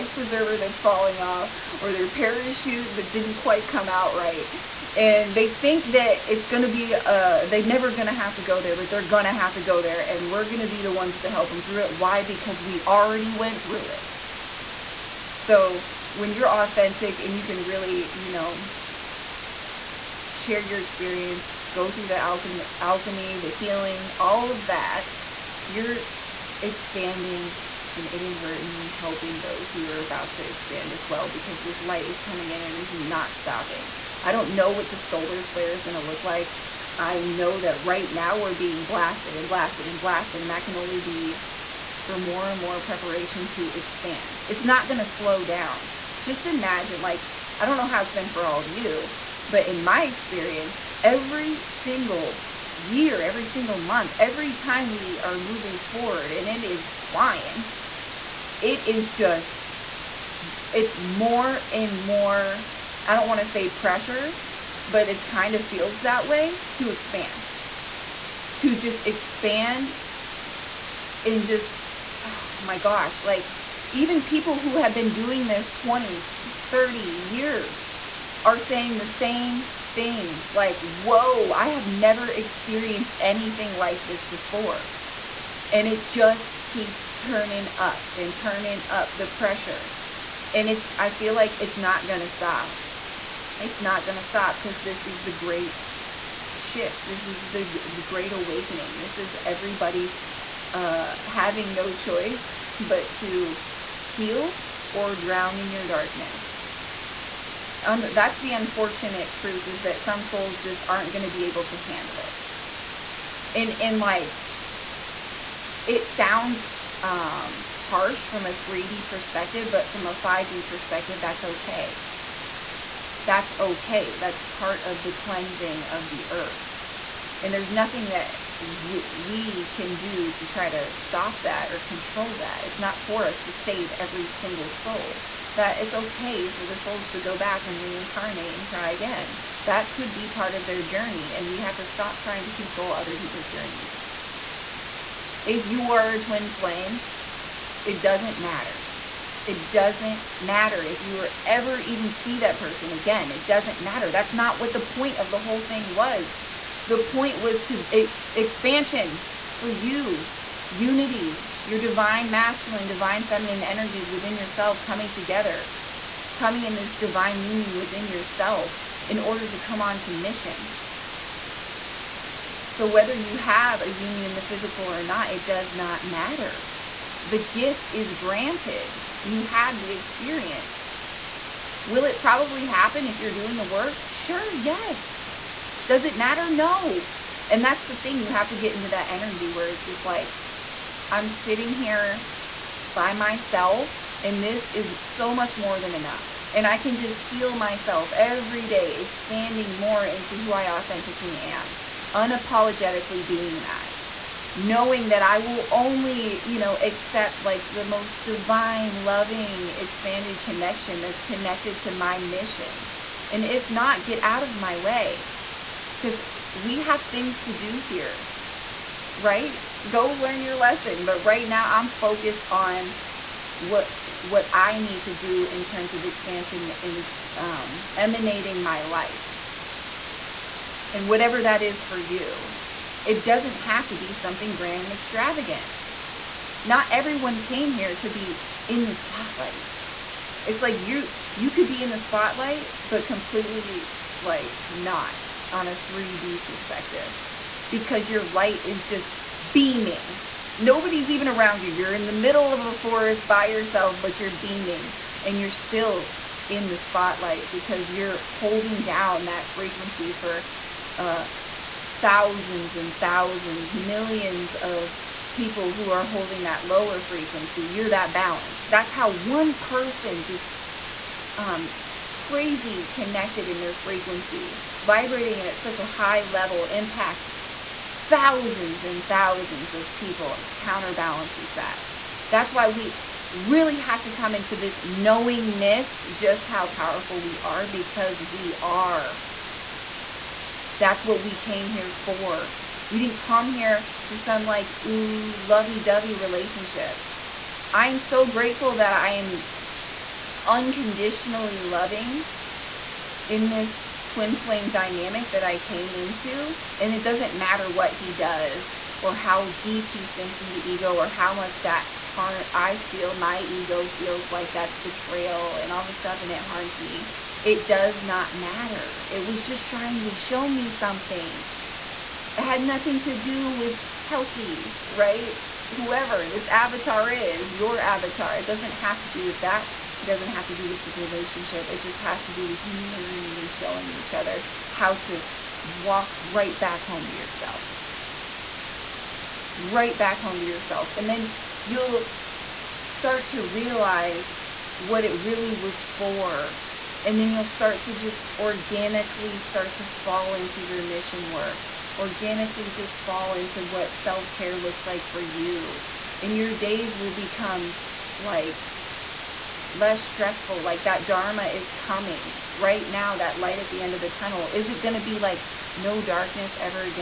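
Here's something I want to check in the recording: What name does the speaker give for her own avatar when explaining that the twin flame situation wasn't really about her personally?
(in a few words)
Kelsey.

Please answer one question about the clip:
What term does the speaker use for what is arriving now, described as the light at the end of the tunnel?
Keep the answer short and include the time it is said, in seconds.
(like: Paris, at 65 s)
Dharma, at 361 s.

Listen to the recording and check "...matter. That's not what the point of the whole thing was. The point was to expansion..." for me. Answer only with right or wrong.
right.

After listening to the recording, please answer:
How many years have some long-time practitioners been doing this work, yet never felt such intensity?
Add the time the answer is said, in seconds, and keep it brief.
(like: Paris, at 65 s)
20, 30, at 75 s.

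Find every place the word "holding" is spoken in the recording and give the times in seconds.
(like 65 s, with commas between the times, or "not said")
258 s, 266 s.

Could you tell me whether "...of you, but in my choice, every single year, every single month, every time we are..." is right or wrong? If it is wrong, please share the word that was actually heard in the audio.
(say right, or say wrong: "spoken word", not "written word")
wrong: "experience", not "choice".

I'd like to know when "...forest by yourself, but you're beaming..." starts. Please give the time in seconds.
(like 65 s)
252 s.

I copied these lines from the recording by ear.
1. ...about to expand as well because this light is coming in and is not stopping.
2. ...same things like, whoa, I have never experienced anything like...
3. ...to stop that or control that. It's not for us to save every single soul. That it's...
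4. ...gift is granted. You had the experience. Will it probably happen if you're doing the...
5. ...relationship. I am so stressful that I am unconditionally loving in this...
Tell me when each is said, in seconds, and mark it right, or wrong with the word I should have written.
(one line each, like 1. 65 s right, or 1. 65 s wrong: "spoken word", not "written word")
1. 29 s right
2. 79 s right
3. 130 s right
4. 177 s right
5. 296 s wrong: "grateful", not "stressful".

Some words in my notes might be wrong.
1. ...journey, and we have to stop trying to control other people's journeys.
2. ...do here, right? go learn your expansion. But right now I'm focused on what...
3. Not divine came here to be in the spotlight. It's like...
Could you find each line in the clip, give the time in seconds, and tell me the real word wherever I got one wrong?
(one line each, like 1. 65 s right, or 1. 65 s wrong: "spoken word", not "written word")
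1. 140 s right
2. 217 s wrong: "lesson", not "expansion"
3. 236 s wrong: "everyone", not "divine".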